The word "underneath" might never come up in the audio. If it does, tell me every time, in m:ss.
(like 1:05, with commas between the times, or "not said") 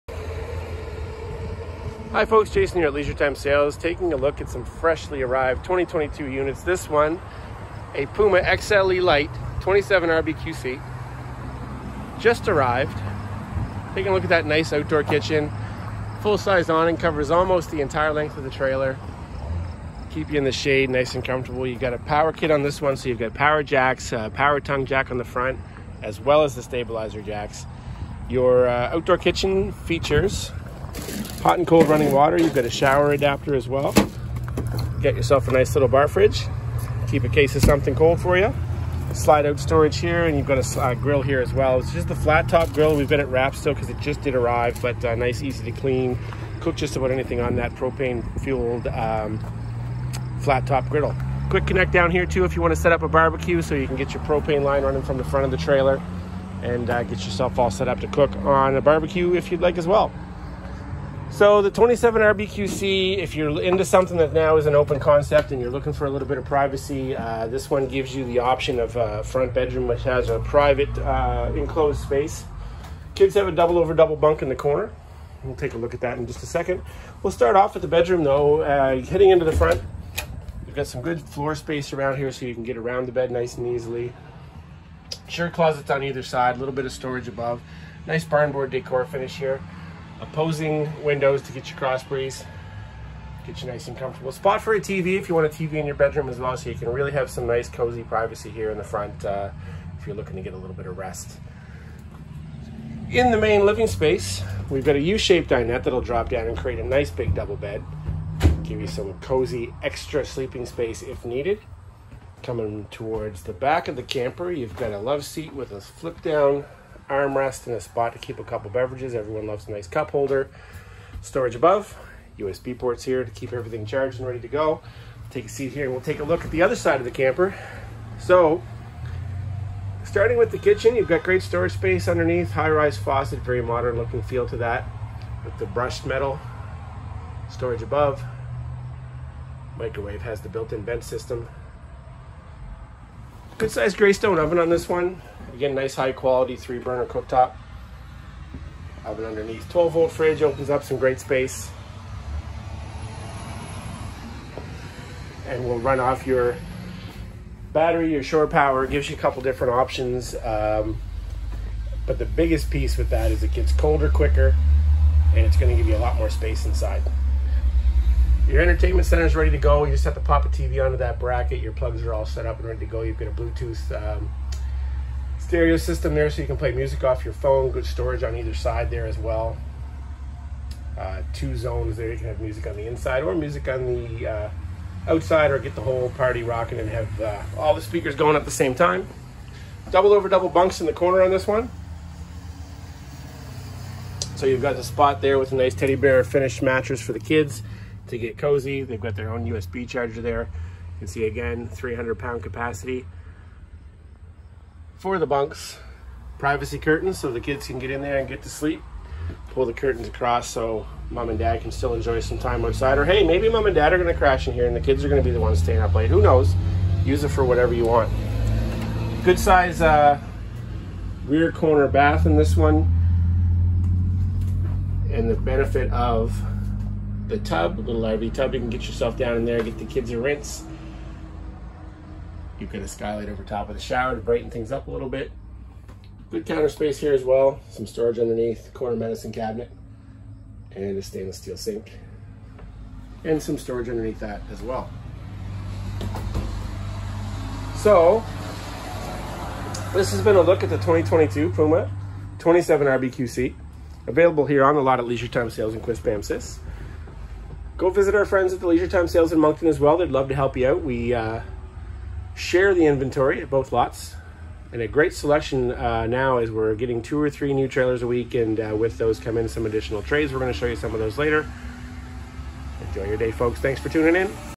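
2:12, 2:29, 3:58, 4:03.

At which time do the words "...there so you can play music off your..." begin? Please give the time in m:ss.
2:56.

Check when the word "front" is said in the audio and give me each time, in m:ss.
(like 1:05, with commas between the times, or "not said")
0:25, 0:55, 1:09, 1:19, 1:38.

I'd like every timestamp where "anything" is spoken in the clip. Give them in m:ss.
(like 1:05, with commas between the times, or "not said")
0:47.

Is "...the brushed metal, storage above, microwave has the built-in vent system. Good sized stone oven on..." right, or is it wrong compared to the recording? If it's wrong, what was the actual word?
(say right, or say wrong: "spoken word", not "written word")
right.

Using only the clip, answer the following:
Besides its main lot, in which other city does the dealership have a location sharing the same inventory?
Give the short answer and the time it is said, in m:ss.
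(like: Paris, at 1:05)
Moncton, at 4:19.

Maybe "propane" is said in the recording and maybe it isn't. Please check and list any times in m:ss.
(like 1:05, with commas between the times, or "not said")
0:47, 0:54.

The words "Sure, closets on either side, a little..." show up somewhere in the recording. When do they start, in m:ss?
1:25.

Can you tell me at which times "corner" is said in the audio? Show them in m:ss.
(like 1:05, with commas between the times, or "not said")
1:14, 3:10, 3:41, 3:58.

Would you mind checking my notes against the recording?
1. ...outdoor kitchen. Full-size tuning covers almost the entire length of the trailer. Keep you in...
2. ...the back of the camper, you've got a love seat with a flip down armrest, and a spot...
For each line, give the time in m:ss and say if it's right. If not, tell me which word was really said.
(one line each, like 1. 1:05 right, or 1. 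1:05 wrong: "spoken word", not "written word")
1. 0:14 wrong: "awning", not "tuning"
2. 1:53 right.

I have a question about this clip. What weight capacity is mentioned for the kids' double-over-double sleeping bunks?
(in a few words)
300 pounds.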